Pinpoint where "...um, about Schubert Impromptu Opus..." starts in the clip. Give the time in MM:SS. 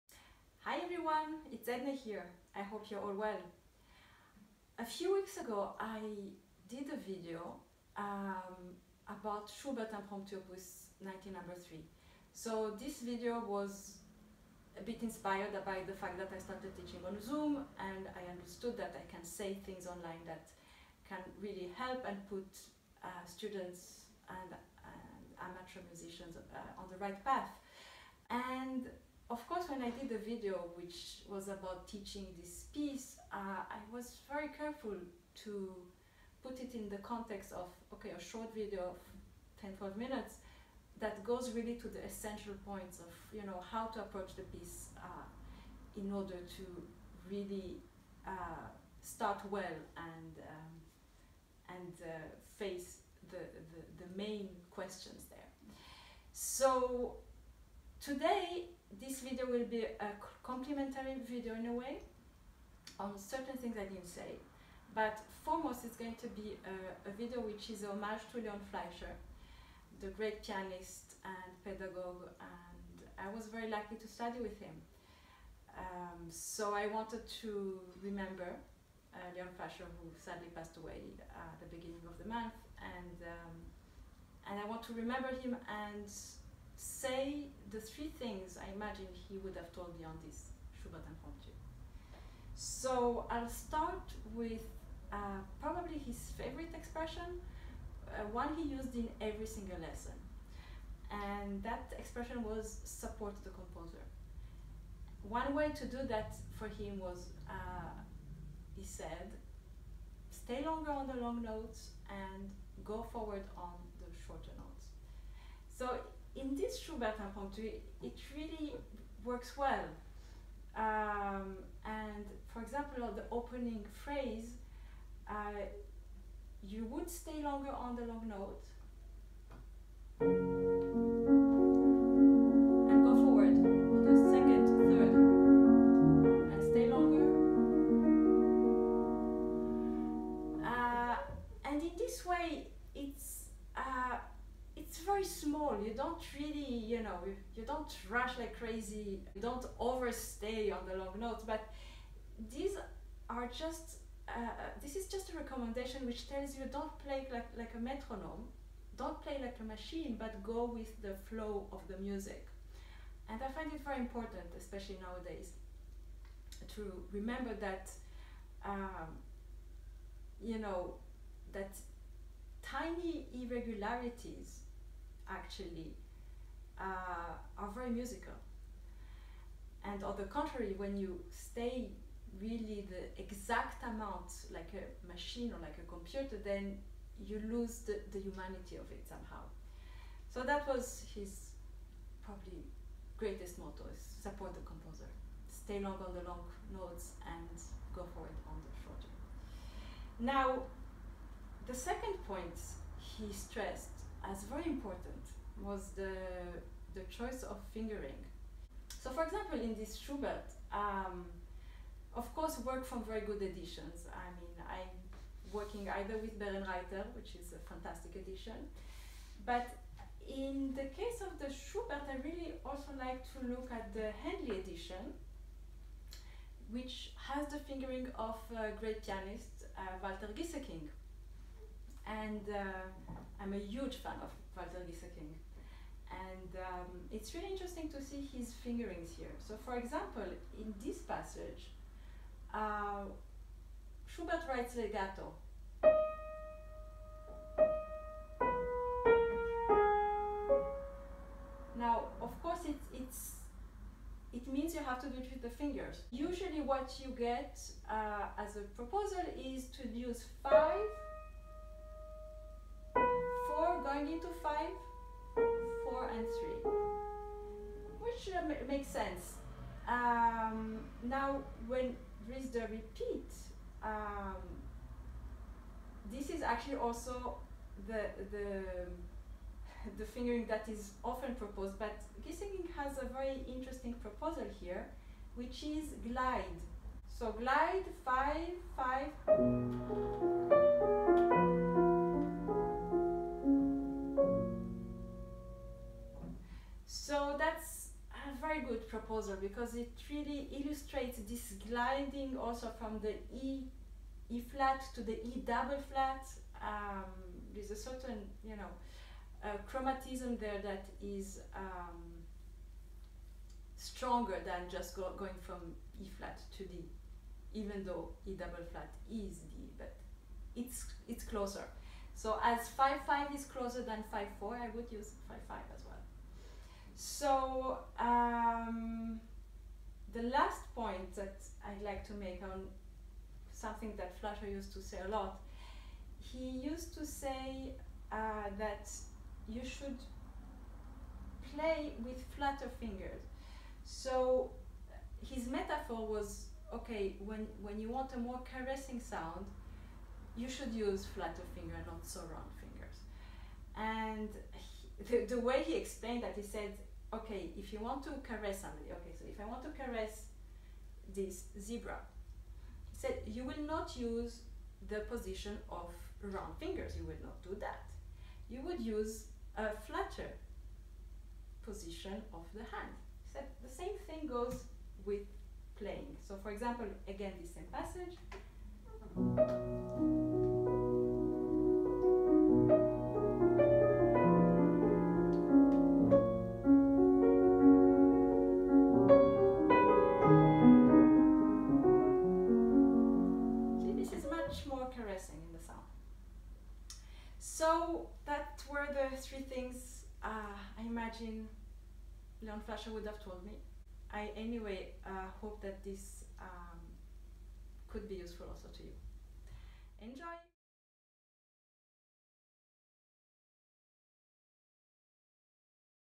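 00:07.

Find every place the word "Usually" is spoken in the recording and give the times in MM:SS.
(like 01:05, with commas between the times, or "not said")
04:16.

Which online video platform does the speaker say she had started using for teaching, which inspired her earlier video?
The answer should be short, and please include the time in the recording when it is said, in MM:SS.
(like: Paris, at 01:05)
Zoom, at 00:17.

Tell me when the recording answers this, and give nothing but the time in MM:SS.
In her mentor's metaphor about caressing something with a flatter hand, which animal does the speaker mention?
06:01.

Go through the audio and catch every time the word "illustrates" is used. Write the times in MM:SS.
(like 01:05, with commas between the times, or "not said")
05:00.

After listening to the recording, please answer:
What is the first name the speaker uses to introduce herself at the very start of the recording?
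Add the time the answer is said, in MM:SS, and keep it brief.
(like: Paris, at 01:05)
Edna, at 00:01.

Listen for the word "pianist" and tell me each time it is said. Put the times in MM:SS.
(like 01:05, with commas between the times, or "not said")
01:10, 03:49.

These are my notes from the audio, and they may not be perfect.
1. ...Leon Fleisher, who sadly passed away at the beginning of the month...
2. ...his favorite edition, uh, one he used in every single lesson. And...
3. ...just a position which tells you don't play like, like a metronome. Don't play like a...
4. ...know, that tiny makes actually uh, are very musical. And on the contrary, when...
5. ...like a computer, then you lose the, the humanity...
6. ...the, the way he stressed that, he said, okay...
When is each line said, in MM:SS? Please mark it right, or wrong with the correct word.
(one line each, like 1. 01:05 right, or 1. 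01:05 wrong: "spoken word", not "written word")
1. 01:19 right
2. 01:35 wrong: "expression", not "edition"
3. 02:35 wrong: "recommendation", not "position"
4. 02:50 wrong: "irregularities", not "makes"
5. 03:05 right
6. 05:55 wrong: "explained", not "stressed".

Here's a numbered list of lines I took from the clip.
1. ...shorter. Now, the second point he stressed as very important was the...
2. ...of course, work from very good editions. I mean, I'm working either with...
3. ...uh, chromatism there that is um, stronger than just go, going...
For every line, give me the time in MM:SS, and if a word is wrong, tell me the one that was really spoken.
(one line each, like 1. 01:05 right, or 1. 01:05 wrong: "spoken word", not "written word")
1. 03:18 right
2. 03:32 right
3. 05:09 right.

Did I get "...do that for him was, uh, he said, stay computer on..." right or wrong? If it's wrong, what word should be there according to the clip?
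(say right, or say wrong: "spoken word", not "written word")
wrong: "longer", not "computer".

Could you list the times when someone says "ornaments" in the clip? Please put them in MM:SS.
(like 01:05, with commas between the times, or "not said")
not said.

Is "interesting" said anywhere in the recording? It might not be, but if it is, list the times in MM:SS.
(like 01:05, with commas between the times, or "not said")
03:57, 04:43.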